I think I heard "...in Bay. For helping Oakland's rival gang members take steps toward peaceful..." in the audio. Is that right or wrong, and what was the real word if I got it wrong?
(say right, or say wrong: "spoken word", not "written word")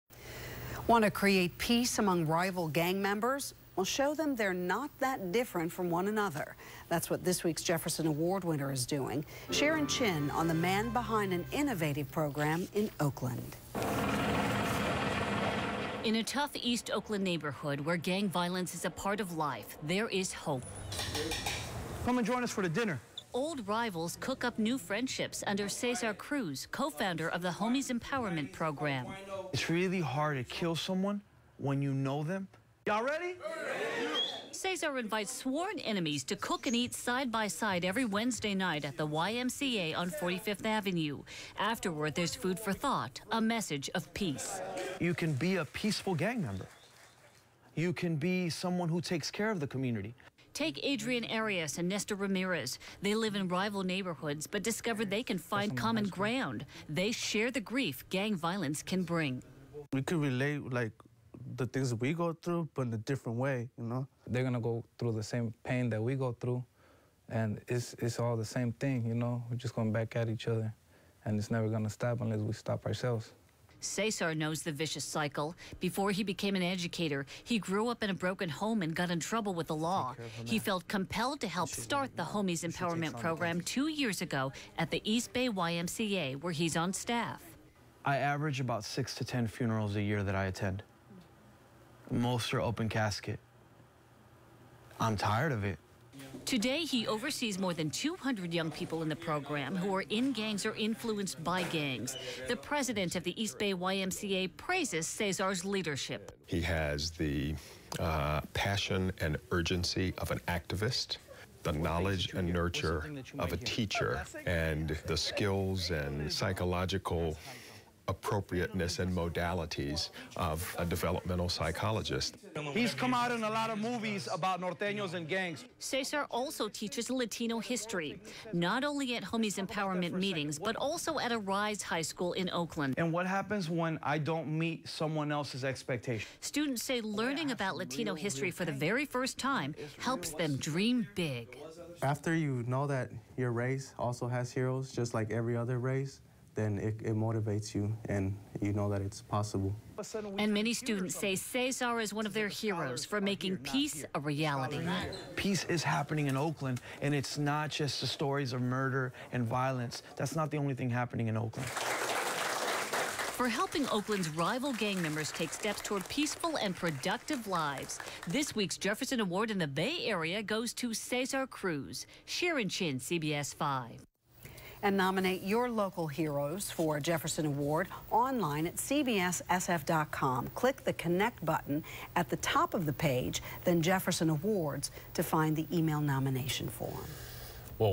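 wrong: "Oakland", not "Bay".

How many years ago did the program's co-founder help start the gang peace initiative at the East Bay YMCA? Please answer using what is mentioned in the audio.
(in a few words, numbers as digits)
2.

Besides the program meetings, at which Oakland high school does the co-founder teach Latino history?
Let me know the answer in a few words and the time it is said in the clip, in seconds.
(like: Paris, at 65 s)
ARISE High School, at 131 s.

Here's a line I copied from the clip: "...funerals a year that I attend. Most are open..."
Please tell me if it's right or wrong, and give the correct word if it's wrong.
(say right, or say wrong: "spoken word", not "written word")
right.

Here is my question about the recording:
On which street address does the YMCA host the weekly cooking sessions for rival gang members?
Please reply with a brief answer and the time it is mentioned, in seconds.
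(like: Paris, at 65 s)
45th Avenue, at 40 s.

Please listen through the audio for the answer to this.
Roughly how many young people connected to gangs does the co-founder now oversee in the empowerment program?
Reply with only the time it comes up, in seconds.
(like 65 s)
97 s.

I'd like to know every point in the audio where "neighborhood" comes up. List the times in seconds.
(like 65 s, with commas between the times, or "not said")
17 s, 53 s.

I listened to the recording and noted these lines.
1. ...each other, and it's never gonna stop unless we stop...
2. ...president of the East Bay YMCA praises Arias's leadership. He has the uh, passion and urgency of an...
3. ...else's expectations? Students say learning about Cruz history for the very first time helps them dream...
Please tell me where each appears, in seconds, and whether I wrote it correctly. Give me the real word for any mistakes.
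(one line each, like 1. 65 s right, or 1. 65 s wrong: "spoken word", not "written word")
1. 70 s right
2. 102 s wrong: "Cesar", not "Arias"
3. 135 s wrong: "Latino", not "Cruz".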